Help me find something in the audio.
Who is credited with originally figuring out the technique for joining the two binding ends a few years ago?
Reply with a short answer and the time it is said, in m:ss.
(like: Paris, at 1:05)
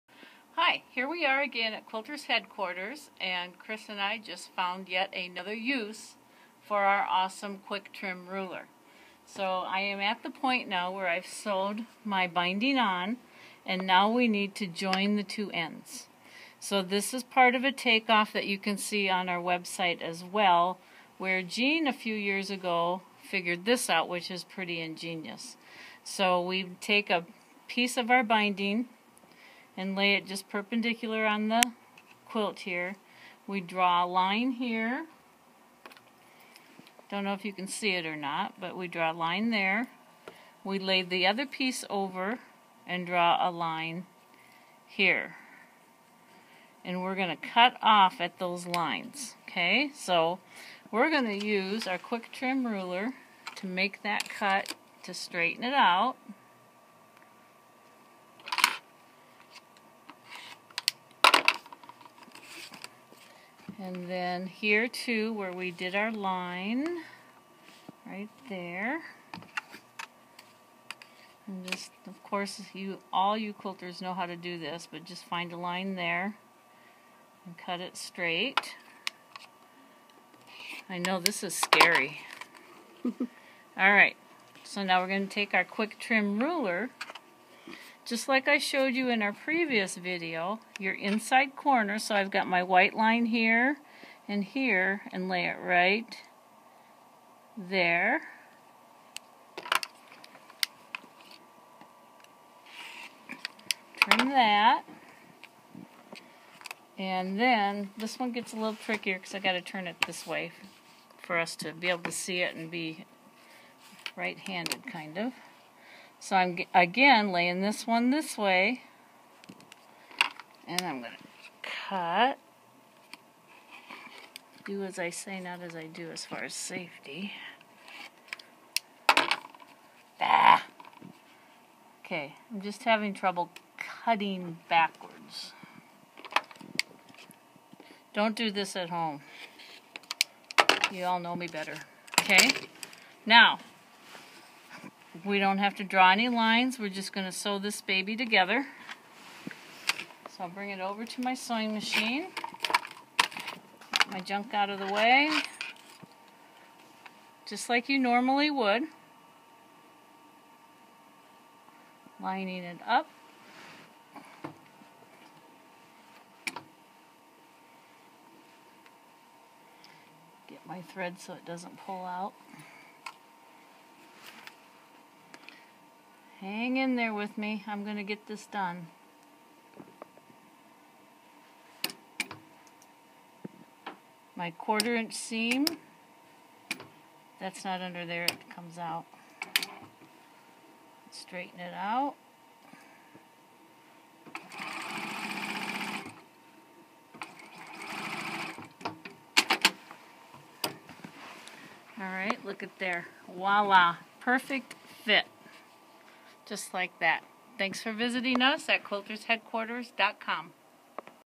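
Jean, at 0:21.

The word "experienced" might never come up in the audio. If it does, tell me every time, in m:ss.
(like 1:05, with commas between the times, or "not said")
not said.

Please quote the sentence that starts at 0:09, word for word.
So I am at the point now where I've sewed my binding on and now we need to join the two ends.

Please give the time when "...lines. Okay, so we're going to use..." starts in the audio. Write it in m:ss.
0:48.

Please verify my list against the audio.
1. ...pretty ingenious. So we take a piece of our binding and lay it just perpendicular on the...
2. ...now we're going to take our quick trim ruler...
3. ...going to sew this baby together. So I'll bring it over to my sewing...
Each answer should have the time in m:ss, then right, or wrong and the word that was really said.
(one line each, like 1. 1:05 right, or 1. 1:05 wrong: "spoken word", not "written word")
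1. 0:24 right
2. 1:24 right
3. 2:27 right.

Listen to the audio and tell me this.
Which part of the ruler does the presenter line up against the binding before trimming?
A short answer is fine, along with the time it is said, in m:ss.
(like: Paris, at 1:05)
inside corner, at 1:30.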